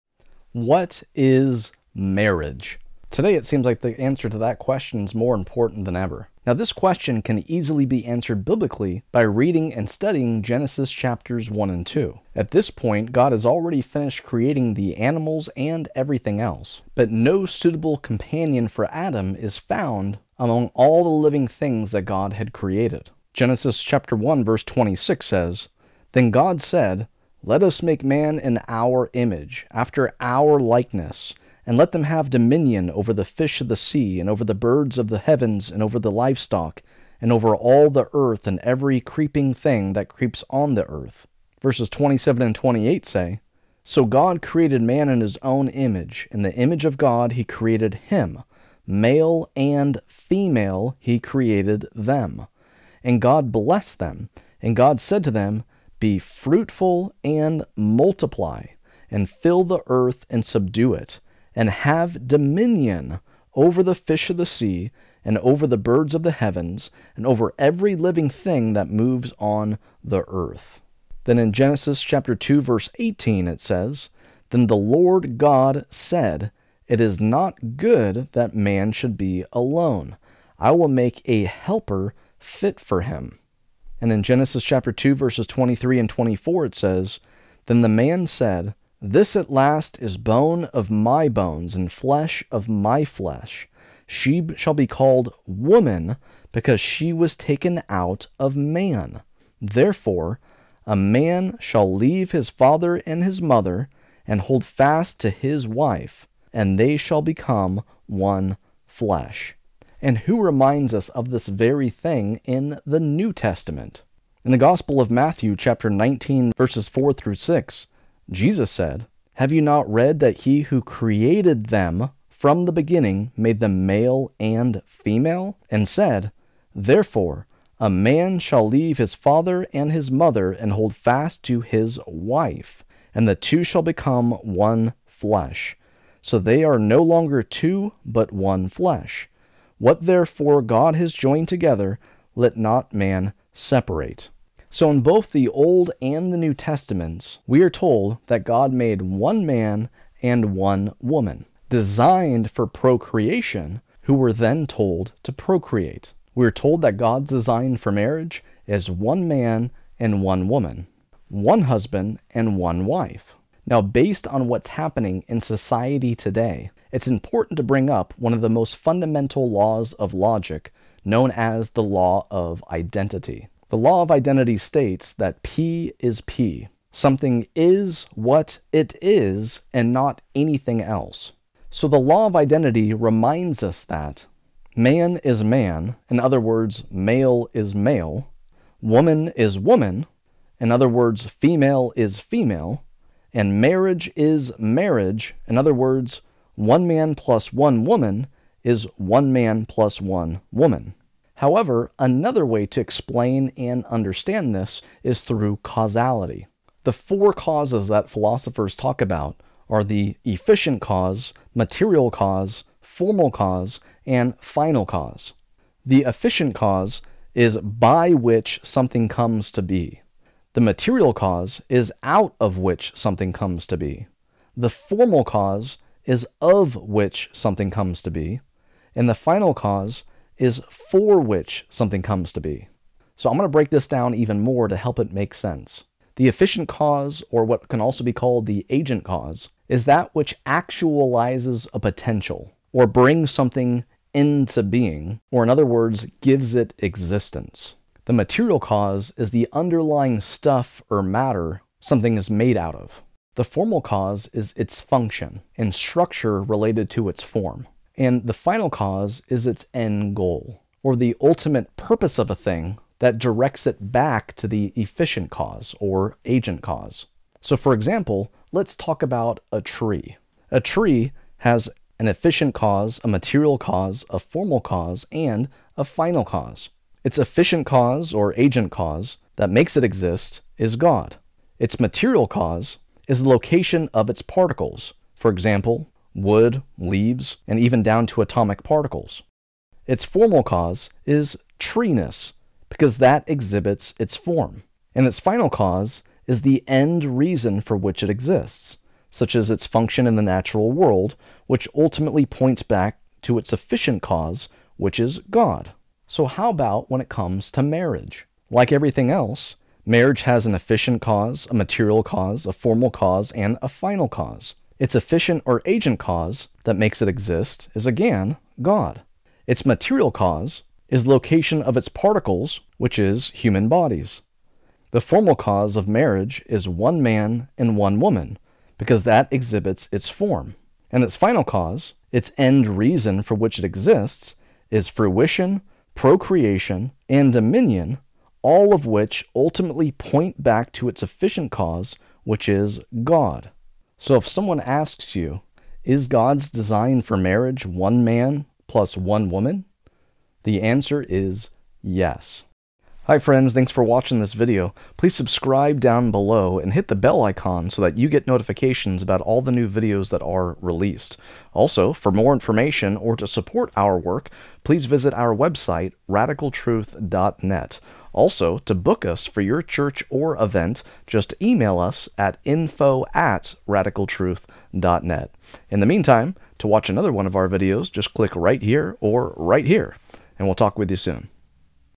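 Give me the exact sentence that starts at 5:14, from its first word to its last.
Its efficient or agent cause that makes it exist is again God.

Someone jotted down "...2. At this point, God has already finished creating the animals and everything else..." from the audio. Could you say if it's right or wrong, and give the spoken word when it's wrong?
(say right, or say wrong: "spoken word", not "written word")
right.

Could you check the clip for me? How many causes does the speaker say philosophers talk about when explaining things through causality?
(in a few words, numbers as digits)
4.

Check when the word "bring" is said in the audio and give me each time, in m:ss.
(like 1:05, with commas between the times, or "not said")
2:47, 4:02.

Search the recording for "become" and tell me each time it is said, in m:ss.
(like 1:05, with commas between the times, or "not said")
1:47, 2:13.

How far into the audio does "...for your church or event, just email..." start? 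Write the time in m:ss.
6:09.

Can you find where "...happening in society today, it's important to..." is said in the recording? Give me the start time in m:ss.
2:44.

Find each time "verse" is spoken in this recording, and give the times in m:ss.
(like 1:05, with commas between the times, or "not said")
0:24, 0:41, 1:12, 1:25, 1:56.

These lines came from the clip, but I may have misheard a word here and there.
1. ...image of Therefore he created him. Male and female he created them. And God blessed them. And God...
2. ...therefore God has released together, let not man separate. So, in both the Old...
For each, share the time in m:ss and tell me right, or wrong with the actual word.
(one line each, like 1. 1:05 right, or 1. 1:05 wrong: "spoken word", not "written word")
1. 0:46 wrong: "God", not "Therefore"
2. 2:20 wrong: "joined", not "released".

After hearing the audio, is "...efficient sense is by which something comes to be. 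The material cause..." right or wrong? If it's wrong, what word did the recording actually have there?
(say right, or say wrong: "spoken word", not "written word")
wrong: "cause", not "sense".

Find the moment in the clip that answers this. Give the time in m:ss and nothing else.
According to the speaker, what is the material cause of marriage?
5:23.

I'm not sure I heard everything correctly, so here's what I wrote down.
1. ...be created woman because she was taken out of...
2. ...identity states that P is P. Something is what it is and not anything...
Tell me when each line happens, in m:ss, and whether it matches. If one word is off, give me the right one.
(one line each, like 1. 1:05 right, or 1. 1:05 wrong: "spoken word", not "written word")
1. 1:34 wrong: "called", not "created"
2. 2:54 right.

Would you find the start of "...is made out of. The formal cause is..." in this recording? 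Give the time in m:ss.
4:12.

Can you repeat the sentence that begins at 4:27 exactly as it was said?
So, for example, let's talk about a tree.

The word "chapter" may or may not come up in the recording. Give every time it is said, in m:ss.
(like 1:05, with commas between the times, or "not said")
0:10, 0:23, 1:12, 1:24, 1:55.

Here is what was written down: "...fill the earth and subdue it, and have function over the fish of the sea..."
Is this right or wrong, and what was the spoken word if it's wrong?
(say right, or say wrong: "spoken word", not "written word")
wrong: "dominion", not "function".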